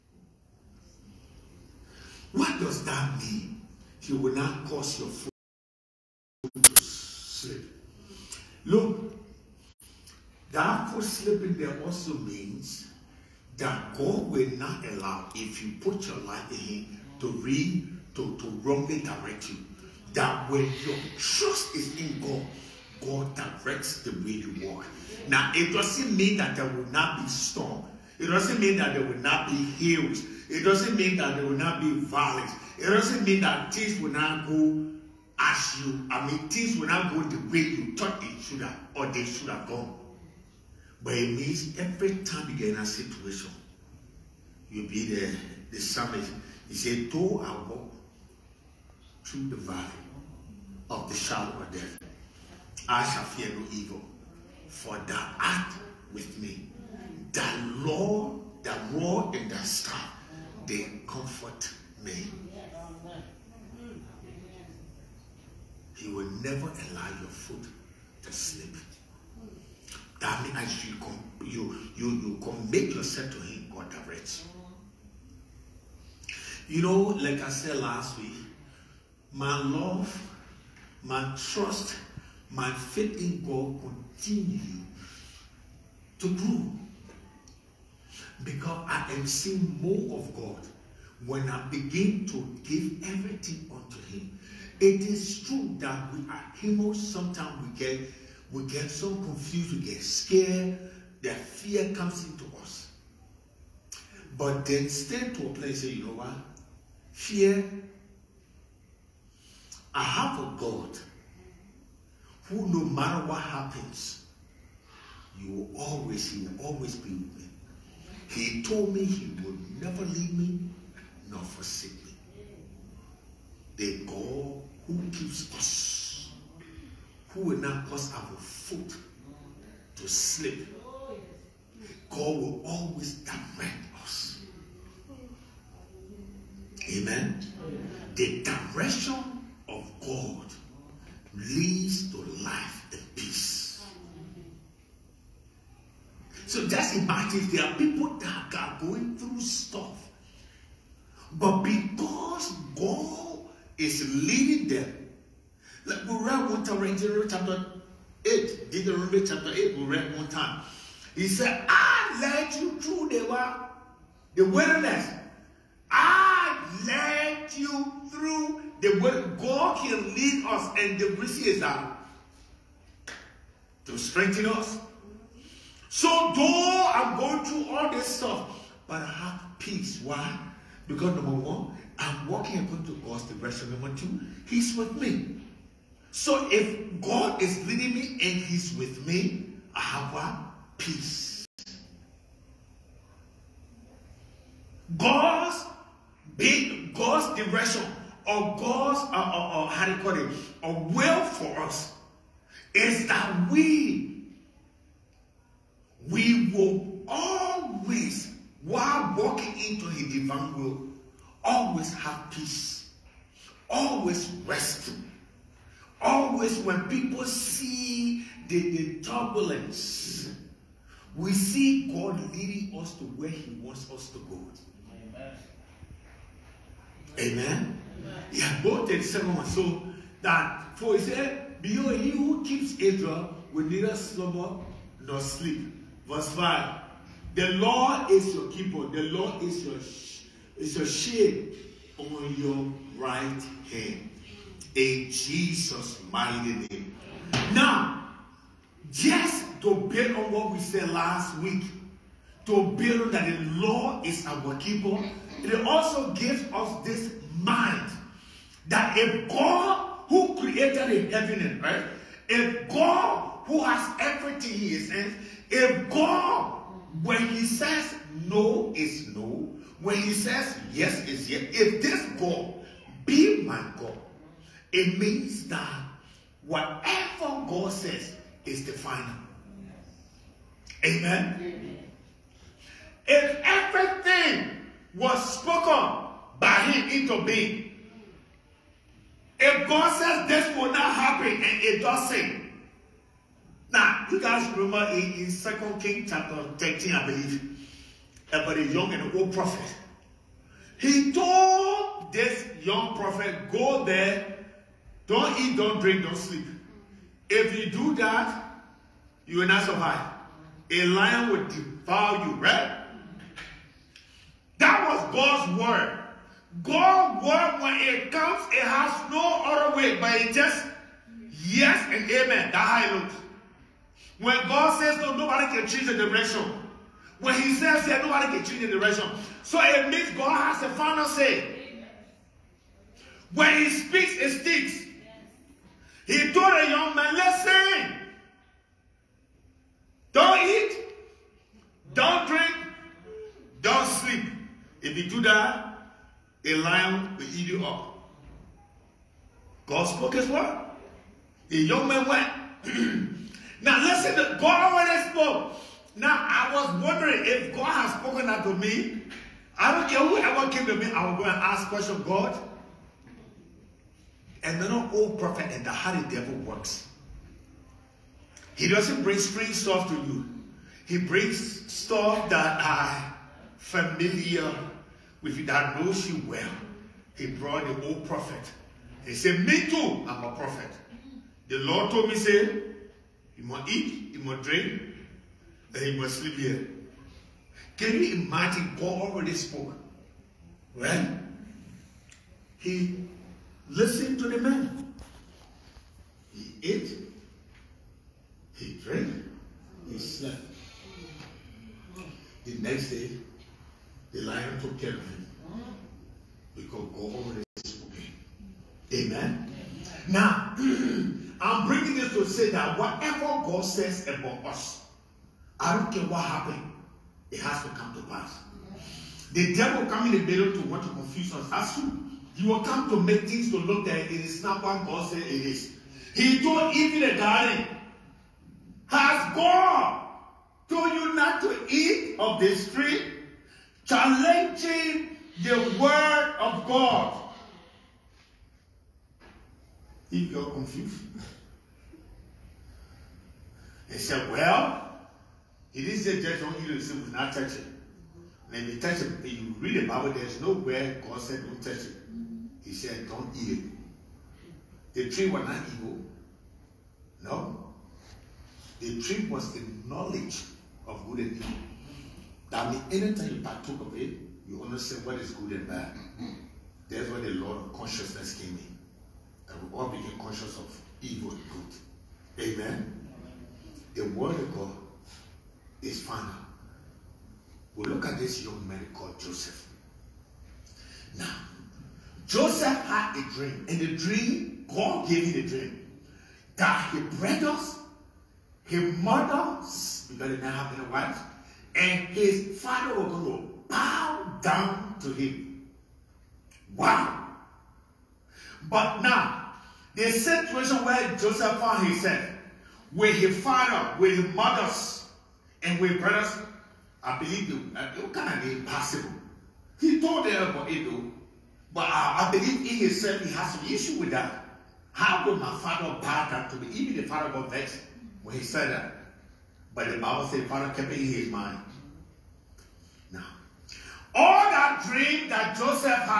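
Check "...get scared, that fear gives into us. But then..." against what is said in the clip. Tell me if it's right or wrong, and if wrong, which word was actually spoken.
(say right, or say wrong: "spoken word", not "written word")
wrong: "comes", not "gives".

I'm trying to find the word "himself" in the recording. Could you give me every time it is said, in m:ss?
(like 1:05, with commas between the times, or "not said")
8:21, 8:32.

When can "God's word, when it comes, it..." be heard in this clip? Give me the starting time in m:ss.
5:16.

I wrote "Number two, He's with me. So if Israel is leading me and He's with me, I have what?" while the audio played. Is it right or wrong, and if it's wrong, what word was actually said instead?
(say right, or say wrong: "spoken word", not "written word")
wrong: "God", not "Israel".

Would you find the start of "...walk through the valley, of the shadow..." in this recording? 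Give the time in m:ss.
0:47.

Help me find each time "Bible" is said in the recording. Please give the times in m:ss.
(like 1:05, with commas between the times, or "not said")
7:29, 8:39.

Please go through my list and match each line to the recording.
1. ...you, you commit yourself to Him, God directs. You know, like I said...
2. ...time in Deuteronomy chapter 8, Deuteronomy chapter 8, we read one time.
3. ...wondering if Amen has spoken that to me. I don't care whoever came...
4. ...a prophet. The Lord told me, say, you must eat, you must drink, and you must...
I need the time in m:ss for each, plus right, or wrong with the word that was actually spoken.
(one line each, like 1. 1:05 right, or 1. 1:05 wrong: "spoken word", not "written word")
1. 1:11 right
2. 2:36 right
3. 5:56 wrong: "God", not "Amen"
4. 6:20 right.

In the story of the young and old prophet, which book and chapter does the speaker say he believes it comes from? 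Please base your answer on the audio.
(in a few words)
2 Kings chapter 13.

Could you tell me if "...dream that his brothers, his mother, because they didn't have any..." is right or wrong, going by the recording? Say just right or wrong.
right.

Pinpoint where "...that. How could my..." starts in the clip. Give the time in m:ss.
8:34.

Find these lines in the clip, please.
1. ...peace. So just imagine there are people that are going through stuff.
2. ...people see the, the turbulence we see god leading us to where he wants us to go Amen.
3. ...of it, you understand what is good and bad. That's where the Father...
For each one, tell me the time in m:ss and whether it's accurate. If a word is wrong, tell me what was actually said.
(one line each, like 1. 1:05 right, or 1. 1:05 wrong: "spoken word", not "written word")
1. 2:23 right
2. 3:36 right
3. 7:43 wrong: "Lord", not "Father".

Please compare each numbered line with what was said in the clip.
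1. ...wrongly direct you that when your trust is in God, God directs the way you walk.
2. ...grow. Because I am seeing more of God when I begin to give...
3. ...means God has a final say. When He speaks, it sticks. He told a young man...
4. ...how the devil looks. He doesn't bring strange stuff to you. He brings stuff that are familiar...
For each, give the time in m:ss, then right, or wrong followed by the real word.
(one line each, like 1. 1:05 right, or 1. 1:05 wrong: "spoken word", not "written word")
1. 0:18 right
2. 1:26 right
3. 5:29 right
4. 6:05 wrong: "works", not "looks".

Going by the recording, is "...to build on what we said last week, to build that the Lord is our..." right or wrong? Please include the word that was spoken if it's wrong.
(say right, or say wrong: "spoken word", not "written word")
right.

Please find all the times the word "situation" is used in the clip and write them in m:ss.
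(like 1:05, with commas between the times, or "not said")
0:42, 8:20.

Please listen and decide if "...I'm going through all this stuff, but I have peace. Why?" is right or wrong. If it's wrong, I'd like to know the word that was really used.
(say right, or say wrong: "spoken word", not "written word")
right.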